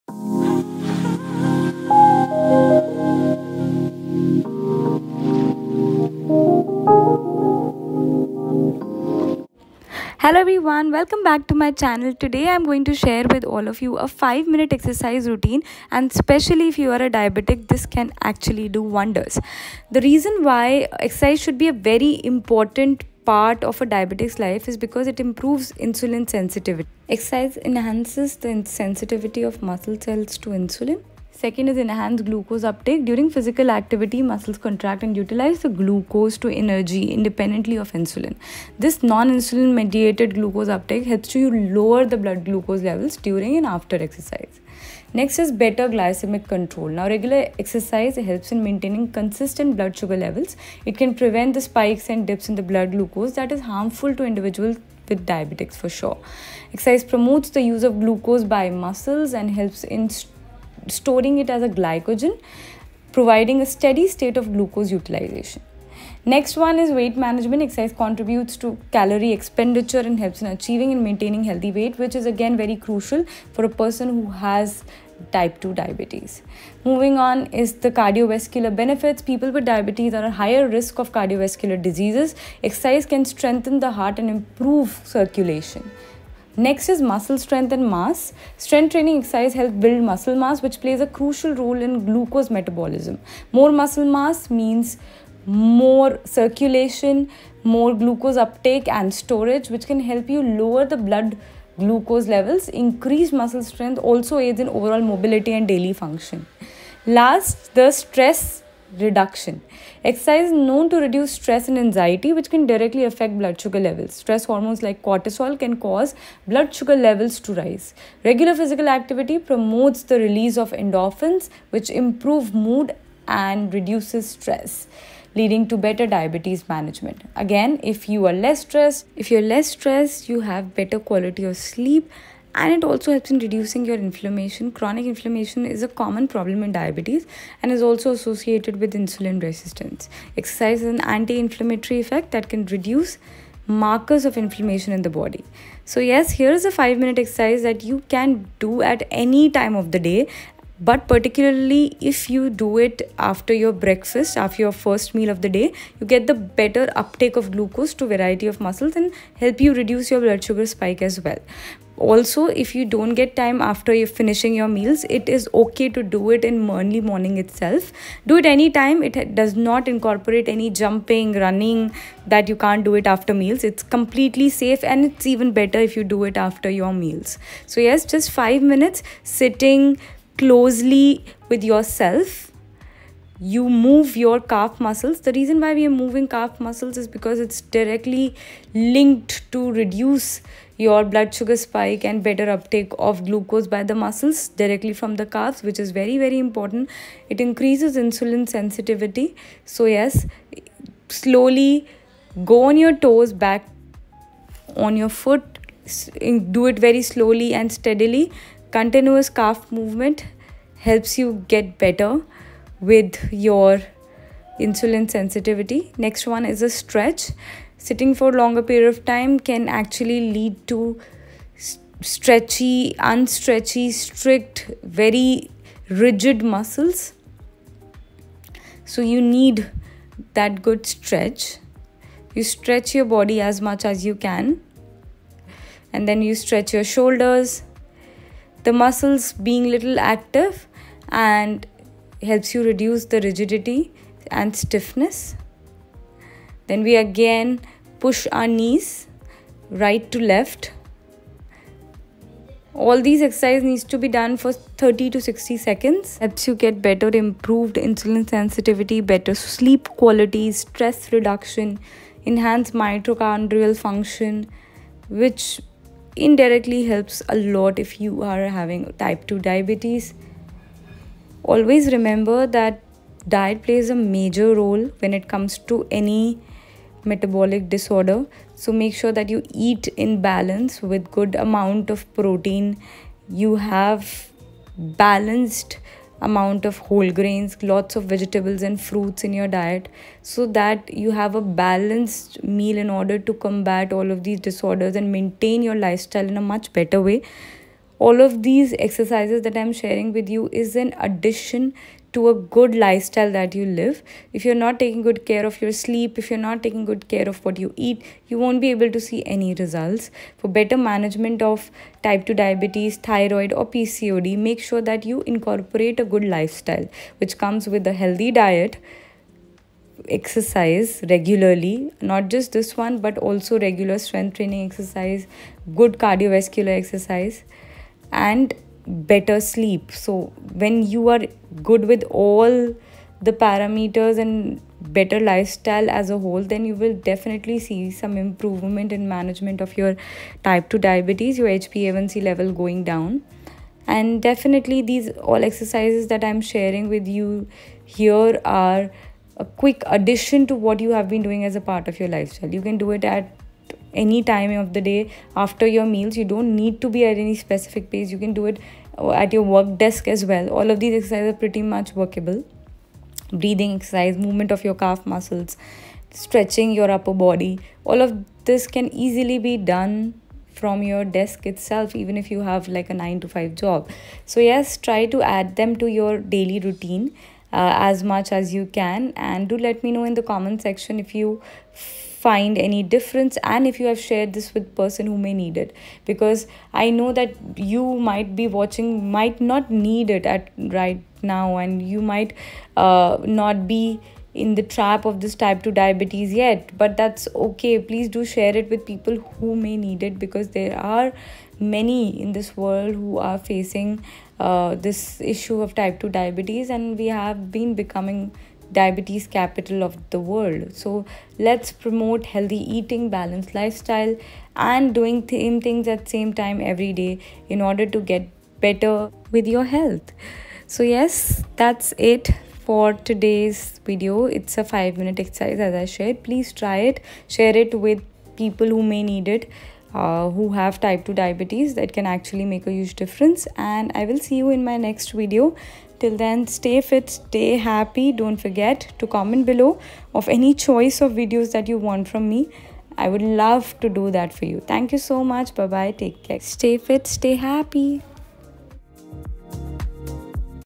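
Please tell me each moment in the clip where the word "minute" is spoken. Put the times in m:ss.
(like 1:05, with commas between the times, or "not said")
0:14, 2:26, 2:58, 7:04.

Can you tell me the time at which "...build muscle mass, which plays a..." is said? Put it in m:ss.
1:29.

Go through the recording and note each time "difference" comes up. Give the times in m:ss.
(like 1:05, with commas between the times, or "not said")
6:22, 7:12.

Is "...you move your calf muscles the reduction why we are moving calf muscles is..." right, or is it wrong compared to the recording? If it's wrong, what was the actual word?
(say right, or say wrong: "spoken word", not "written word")
wrong: "reason", not "reduction".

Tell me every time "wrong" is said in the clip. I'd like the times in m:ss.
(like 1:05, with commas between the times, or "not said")
not said.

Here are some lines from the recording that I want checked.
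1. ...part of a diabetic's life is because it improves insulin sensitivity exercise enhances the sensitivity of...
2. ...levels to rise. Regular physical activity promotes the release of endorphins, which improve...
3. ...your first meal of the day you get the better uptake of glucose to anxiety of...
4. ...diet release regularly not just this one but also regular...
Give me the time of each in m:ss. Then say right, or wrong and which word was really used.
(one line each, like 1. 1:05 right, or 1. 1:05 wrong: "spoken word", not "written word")
1. 0:23 right
2. 1:56 right
3. 2:34 wrong: "variety", not "anxiety"
4. 5:18 wrong: "exercise", not "release".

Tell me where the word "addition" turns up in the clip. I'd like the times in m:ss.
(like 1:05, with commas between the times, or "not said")
5:00, 5:49.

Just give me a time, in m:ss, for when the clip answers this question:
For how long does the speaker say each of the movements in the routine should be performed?
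4:14.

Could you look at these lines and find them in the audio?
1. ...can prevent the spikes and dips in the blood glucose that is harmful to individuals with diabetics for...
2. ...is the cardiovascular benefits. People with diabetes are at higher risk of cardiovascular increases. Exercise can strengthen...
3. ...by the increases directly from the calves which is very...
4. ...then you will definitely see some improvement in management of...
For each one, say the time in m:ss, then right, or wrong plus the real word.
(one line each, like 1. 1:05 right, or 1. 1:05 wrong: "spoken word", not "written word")
1. 0:50 right
2. 1:17 wrong: "diseases", not "increases"
3. 3:13 wrong: "muscles", not "increases"
4. 5:36 right.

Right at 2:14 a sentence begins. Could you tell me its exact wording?
Chronic inflammation is a common problem in diabetes and is also associated with insulin resistance.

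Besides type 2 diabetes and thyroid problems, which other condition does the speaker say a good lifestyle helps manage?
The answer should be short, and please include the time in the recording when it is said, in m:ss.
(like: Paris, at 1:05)
PCOD, at 5:13.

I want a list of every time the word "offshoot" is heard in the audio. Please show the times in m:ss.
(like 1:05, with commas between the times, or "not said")
not said.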